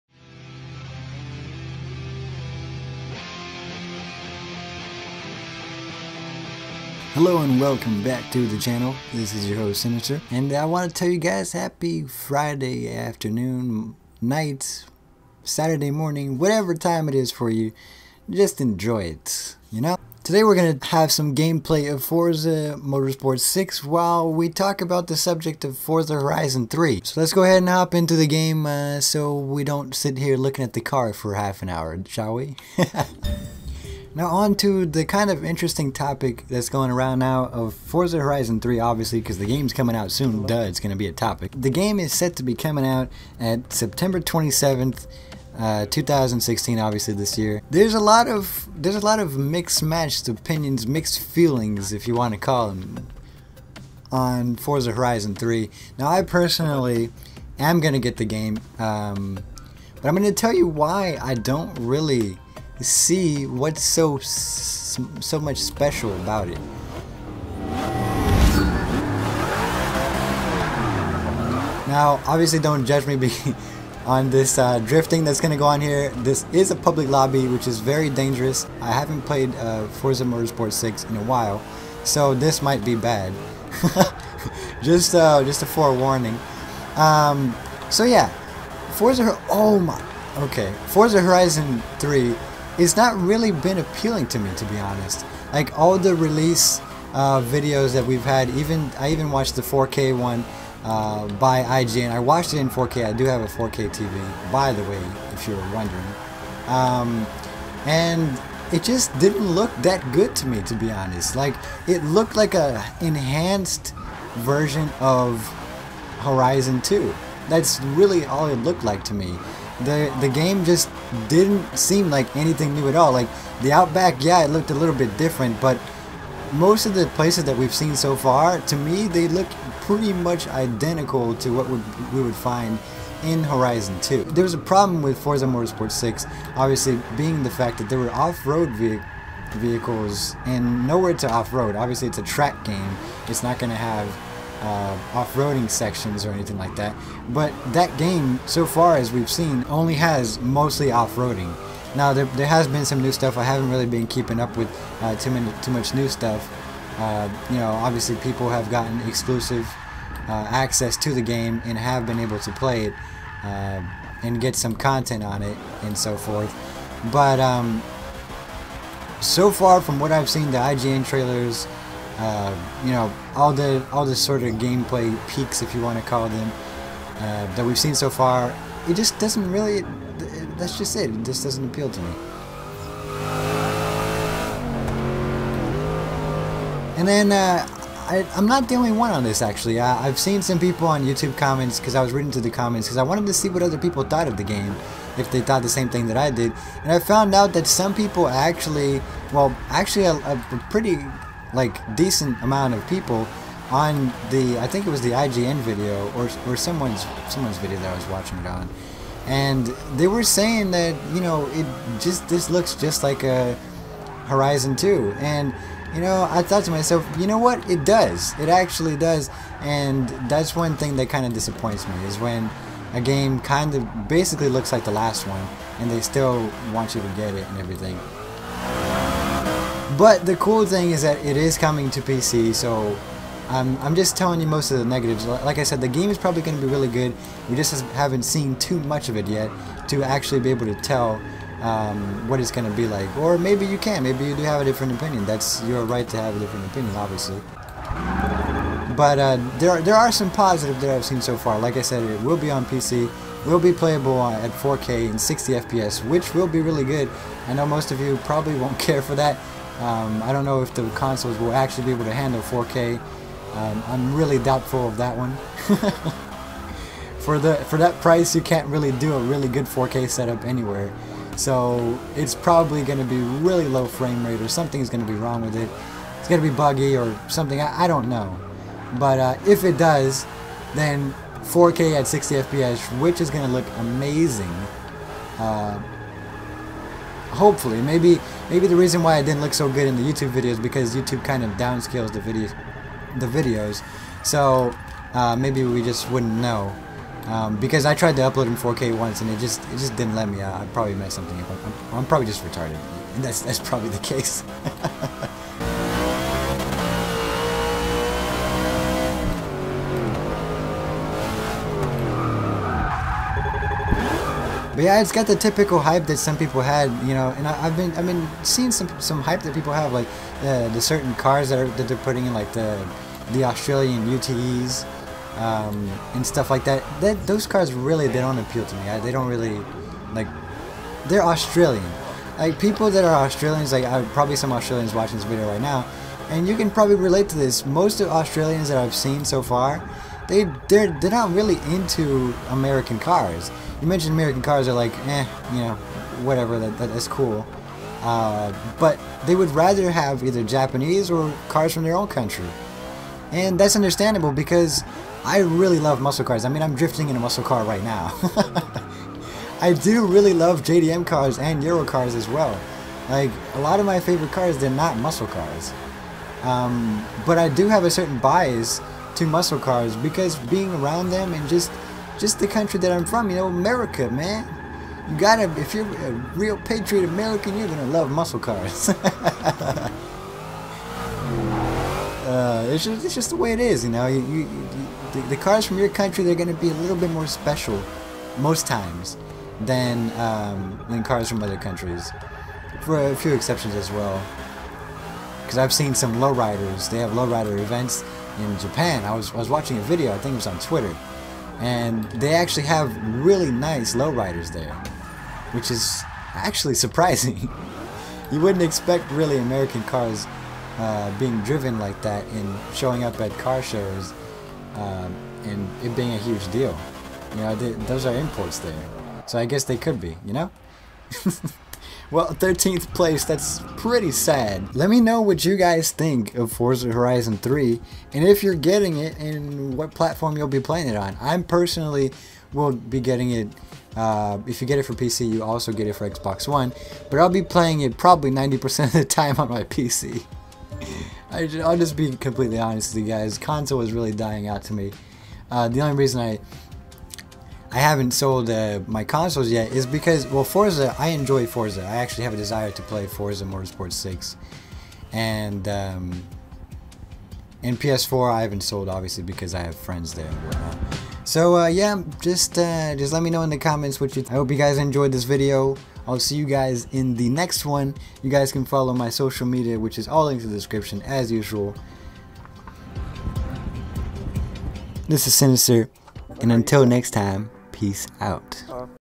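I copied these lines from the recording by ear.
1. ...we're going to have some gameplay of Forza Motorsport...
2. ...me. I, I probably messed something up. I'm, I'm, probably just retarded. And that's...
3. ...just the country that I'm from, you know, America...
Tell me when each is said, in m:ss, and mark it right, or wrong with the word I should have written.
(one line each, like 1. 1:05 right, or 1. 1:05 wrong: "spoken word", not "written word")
1. 0:20 right
2. 5:00 right
3. 6:12 right.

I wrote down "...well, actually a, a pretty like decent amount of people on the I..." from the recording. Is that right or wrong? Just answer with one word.
right.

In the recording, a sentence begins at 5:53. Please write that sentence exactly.
And that's understandable because I really love muscle cars.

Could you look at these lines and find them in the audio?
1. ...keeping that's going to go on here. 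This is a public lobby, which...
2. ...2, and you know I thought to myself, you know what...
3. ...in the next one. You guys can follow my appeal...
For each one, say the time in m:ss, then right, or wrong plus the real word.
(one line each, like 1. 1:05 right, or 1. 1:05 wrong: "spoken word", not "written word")
1. 1:14 wrong: "drifting", not "keeping"
2. 3:34 right
3. 7:46 wrong: "social", not "appeal".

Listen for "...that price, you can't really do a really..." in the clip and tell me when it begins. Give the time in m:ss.
4:27.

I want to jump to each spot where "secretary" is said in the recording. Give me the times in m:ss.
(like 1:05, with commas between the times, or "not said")
not said.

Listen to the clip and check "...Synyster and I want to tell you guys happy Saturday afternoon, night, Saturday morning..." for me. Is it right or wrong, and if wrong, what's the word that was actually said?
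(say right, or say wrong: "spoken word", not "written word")
wrong: "Friday", not "Saturday".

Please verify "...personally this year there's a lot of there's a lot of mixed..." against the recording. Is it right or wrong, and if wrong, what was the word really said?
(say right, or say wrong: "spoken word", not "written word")
wrong: "obviously", not "personally".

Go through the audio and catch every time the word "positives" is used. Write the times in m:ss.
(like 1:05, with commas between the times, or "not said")
4:10.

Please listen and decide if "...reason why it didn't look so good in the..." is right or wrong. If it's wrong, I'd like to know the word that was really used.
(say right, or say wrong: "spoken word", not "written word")
right.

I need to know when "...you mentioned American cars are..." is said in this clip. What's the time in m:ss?
5:43.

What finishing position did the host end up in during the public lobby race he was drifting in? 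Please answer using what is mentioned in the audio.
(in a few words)
13th place.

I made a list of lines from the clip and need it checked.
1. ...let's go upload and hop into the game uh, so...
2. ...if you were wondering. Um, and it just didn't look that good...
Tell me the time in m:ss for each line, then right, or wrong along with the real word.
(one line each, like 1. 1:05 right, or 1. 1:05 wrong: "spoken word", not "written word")
1. 0:27 wrong: "ahead", not "upload"
2. 1:45 right.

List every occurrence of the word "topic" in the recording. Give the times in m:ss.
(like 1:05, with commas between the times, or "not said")
0:35, 0:41.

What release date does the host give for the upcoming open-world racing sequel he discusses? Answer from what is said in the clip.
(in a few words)
September 27th.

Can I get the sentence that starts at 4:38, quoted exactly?
But uh, if it does, then 4K at 60 FPS, which is going to look amazing.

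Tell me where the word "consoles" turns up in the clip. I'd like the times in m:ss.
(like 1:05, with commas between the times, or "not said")
4:20, 7:23, 7:29.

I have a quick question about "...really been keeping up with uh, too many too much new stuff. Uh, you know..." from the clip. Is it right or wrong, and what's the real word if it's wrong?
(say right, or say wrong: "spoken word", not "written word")
right.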